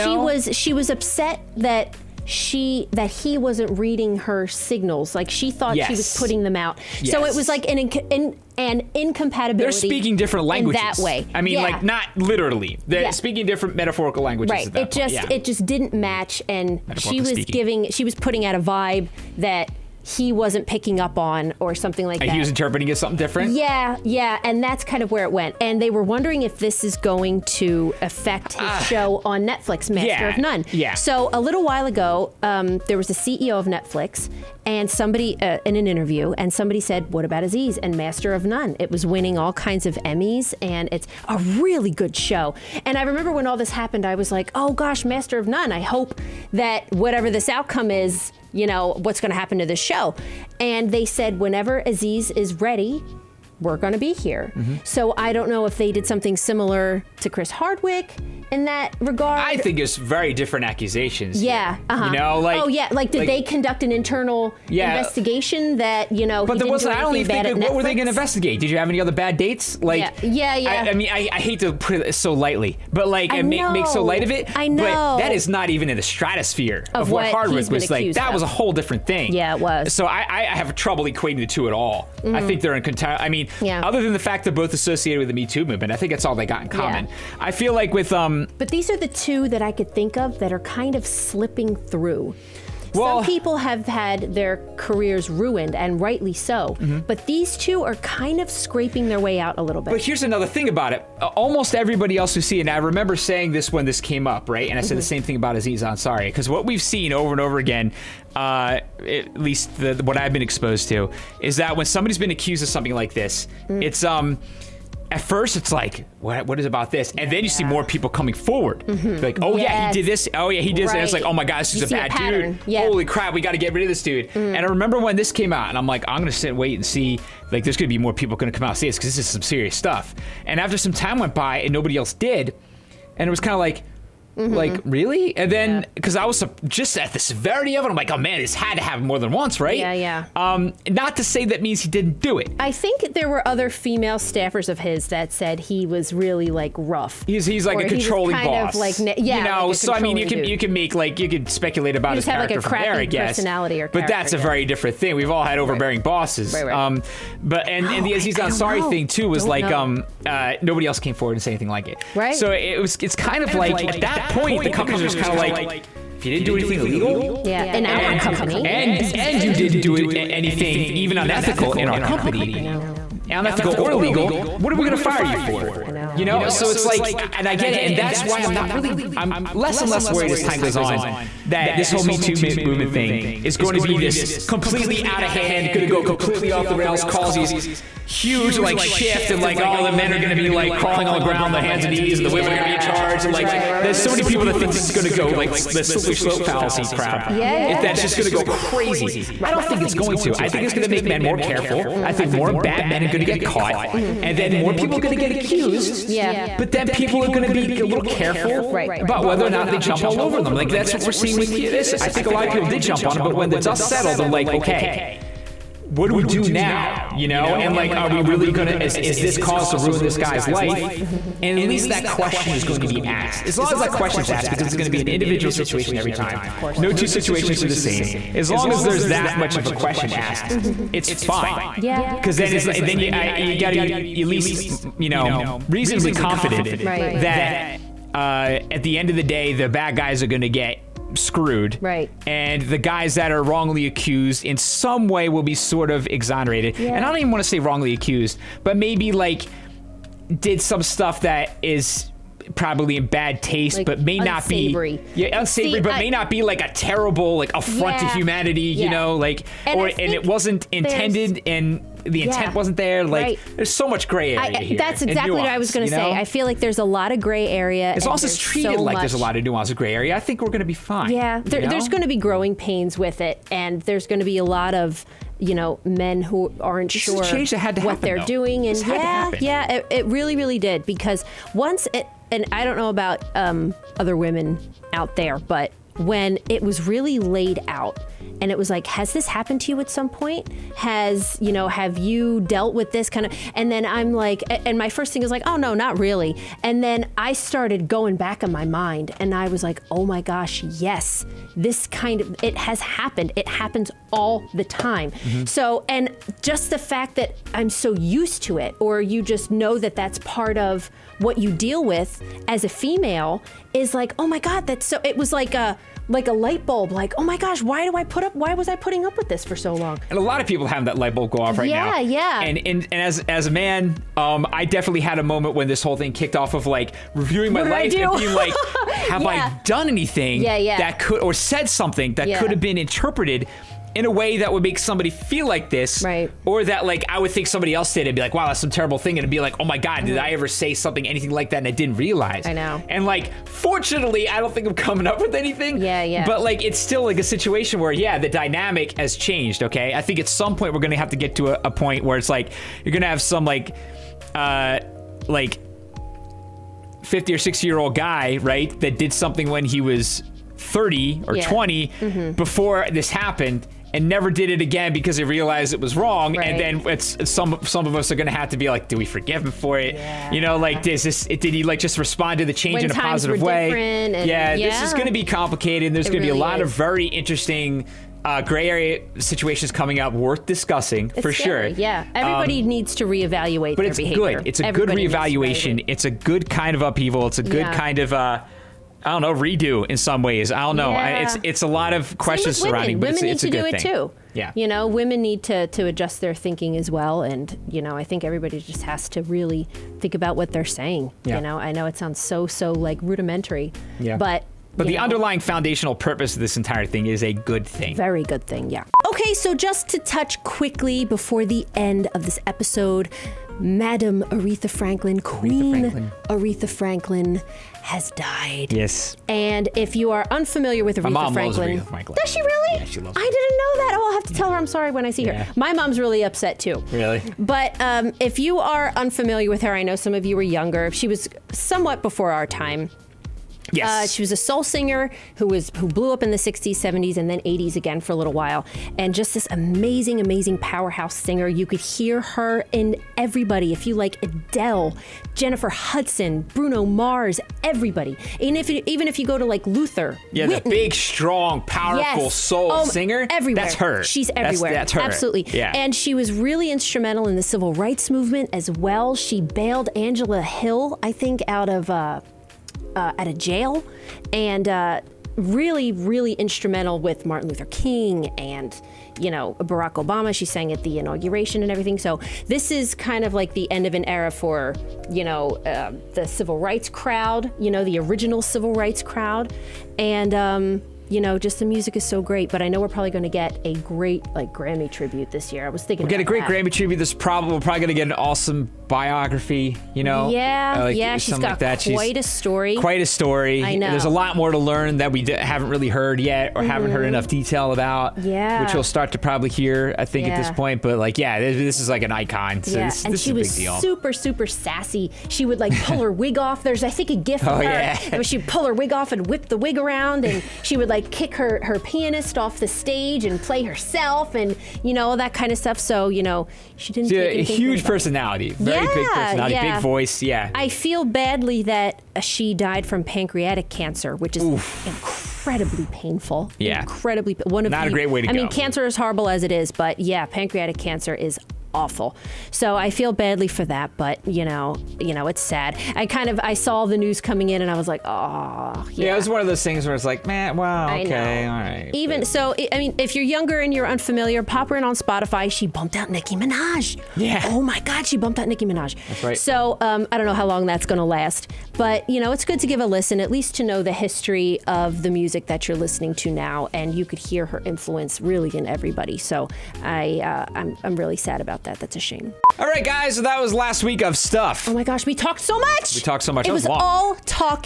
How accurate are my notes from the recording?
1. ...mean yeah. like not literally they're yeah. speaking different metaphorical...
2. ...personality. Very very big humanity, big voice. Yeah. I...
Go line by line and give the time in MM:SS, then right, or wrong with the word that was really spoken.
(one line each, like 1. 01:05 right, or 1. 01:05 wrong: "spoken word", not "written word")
1. 00:11 right
2. 08:37 wrong: "personality", not "humanity".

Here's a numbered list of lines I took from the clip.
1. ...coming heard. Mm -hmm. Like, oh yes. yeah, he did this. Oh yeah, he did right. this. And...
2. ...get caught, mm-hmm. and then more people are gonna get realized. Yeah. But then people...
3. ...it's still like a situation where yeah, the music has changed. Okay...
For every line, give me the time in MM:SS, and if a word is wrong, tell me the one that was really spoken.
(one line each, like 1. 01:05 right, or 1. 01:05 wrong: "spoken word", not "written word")
1. 01:58 wrong: "forward", not "heard"
2. 03:23 wrong: "accused", not "realized"
3. 05:46 wrong: "dynamic", not "music".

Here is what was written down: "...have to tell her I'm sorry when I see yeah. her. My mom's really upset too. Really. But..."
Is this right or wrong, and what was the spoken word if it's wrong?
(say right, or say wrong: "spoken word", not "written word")
right.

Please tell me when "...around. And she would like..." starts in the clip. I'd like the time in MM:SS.
08:29.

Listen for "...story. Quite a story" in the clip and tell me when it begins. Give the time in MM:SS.
08:12.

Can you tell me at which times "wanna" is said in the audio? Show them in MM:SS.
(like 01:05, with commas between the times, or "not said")
not said.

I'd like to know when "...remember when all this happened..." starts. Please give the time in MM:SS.
00:43.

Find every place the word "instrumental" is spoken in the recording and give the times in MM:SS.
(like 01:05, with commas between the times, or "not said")
07:36, 07:46.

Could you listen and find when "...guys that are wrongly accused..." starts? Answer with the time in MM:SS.
04:02.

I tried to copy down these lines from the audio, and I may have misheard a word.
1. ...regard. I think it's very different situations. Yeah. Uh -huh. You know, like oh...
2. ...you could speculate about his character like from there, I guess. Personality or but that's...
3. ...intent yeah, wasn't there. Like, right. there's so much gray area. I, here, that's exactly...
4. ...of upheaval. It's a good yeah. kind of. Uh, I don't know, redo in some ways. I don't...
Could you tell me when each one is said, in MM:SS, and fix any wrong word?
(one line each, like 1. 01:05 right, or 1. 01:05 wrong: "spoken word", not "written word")
1. 00:59 wrong: "accusations", not "situations"
2. 02:31 right
3. 04:22 right
4. 06:26 right.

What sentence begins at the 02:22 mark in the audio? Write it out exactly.
I think there were other female staffers of his that said he was really like rough.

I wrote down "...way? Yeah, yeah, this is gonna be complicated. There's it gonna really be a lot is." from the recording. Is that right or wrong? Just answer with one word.
right.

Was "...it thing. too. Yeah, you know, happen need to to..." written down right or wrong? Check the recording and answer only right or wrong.
wrong.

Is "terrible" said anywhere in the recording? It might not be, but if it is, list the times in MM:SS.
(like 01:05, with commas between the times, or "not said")
04:16, 05:38.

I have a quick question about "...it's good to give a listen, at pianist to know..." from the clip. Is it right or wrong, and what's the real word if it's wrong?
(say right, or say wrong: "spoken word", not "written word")
wrong: "least", not "pianist".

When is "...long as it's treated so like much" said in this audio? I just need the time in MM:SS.
04:28.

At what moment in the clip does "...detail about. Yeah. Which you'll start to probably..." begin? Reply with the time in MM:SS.
08:17.